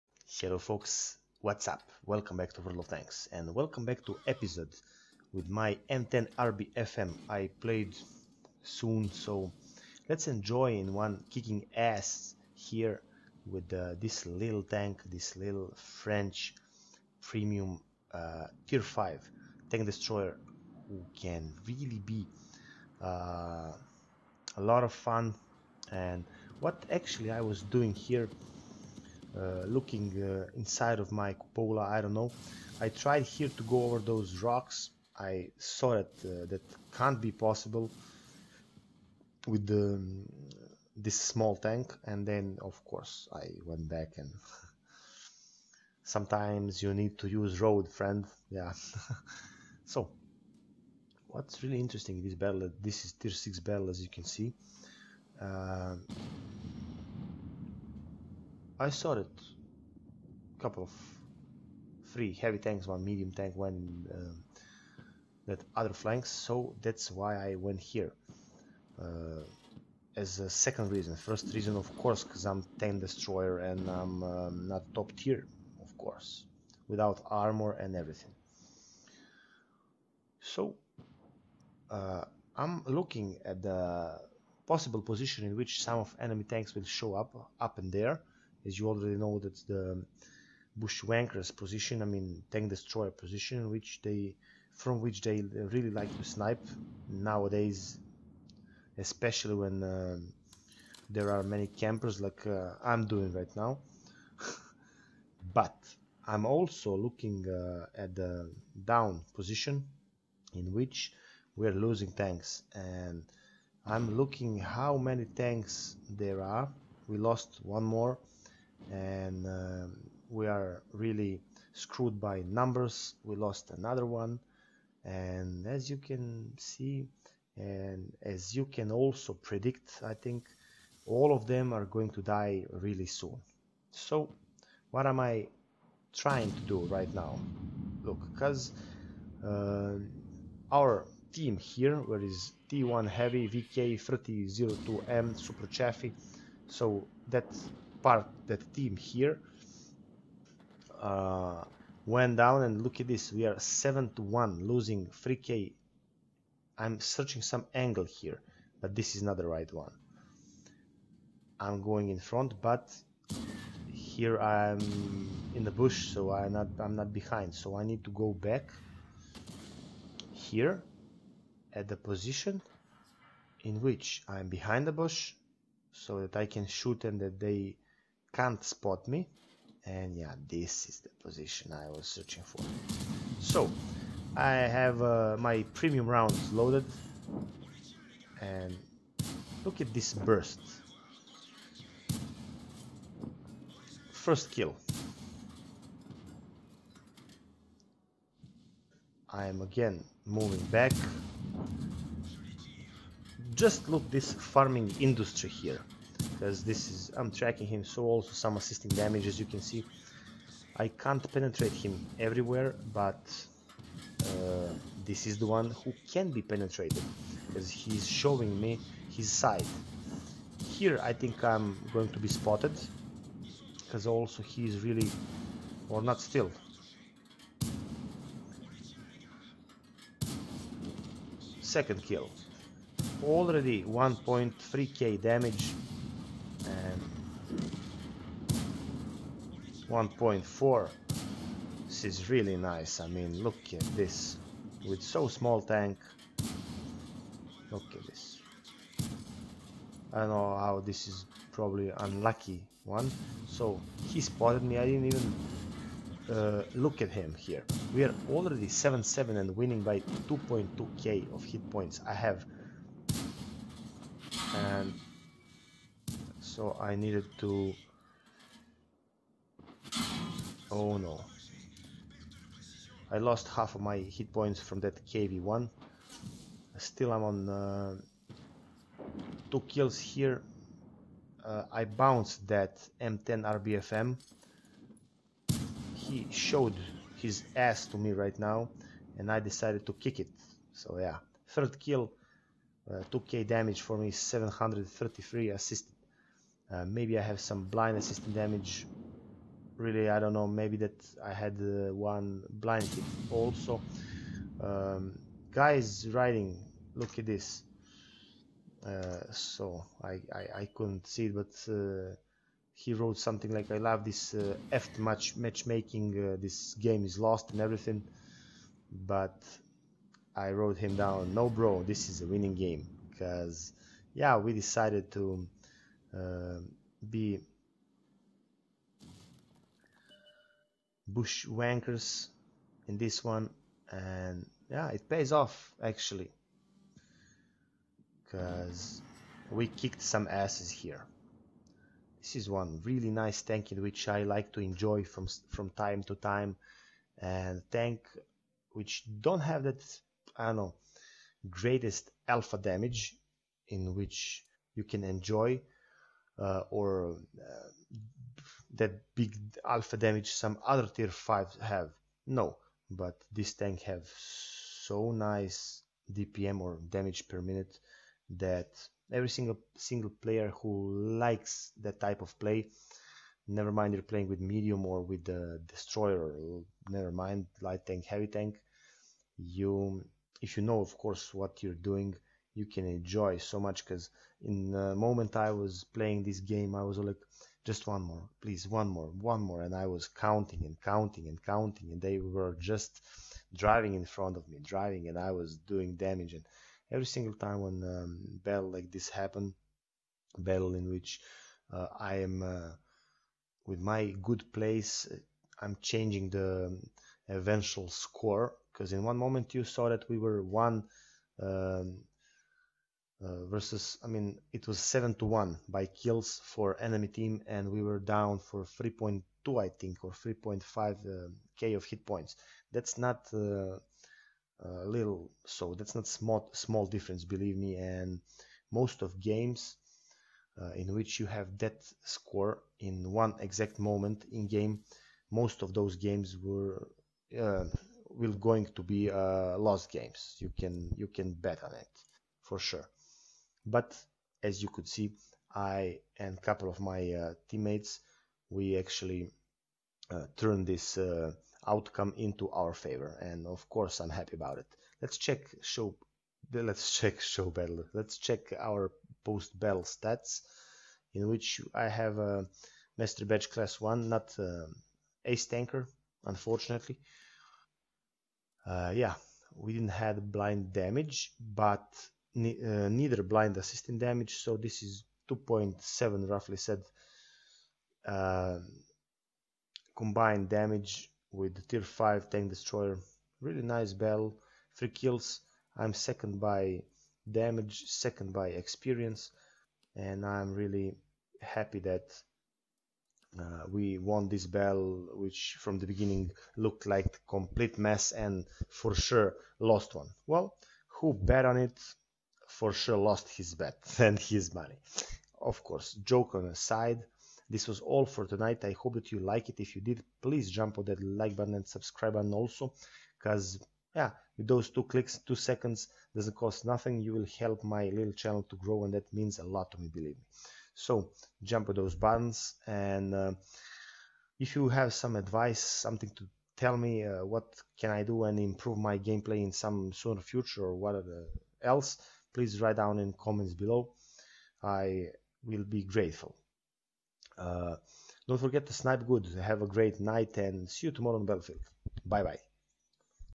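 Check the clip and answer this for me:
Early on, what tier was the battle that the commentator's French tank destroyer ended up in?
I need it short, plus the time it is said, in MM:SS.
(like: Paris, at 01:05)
6, at 00:53.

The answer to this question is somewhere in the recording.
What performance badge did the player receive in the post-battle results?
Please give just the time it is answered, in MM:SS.
07:42.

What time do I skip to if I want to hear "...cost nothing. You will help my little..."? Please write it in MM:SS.
08:36.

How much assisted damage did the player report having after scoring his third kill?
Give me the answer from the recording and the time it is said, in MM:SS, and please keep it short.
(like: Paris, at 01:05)
733, at 04:54.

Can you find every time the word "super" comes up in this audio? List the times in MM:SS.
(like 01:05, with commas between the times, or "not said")
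02:25.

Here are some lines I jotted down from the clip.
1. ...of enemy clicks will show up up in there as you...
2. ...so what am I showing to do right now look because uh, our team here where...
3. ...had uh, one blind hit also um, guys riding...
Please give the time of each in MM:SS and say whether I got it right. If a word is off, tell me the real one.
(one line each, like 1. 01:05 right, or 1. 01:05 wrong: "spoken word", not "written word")
1. 01:25 wrong: "tanks", not "clicks"
2. 02:13 wrong: "trying", not "showing"
3. 05:01 right.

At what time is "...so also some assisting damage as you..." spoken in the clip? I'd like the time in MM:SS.
03:27.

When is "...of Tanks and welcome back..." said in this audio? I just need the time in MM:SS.
00:02.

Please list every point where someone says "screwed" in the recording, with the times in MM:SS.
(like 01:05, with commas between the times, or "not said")
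02:01.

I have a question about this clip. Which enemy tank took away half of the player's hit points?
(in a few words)
KV-1.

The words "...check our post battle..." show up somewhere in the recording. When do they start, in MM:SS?
07:38.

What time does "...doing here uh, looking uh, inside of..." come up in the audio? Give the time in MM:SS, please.
00:27.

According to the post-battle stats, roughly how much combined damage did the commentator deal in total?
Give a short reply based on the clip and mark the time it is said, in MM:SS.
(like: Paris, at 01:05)
2.7k, at 07:55.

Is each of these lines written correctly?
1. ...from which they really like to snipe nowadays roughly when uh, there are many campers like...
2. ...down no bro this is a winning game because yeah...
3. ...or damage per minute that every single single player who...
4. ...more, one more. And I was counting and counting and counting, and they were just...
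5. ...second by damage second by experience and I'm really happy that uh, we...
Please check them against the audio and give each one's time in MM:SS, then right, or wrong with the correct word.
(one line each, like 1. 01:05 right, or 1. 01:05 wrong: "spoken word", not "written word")
1. 01:34 wrong: "especially", not "roughly"
2. 05:20 right
3. 06:06 right
4. 06:28 right
5. 08:05 right.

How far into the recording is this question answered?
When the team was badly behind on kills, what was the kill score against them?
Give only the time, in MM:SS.
02:33.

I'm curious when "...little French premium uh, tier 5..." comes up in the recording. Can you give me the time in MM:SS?
00:15.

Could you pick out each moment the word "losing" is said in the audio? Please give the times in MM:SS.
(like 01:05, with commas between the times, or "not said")
01:51, 02:34.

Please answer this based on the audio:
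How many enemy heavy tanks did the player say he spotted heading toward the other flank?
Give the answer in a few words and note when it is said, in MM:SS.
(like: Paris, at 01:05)
3, at 01:02.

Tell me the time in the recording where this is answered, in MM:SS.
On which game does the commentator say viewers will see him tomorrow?
09:01.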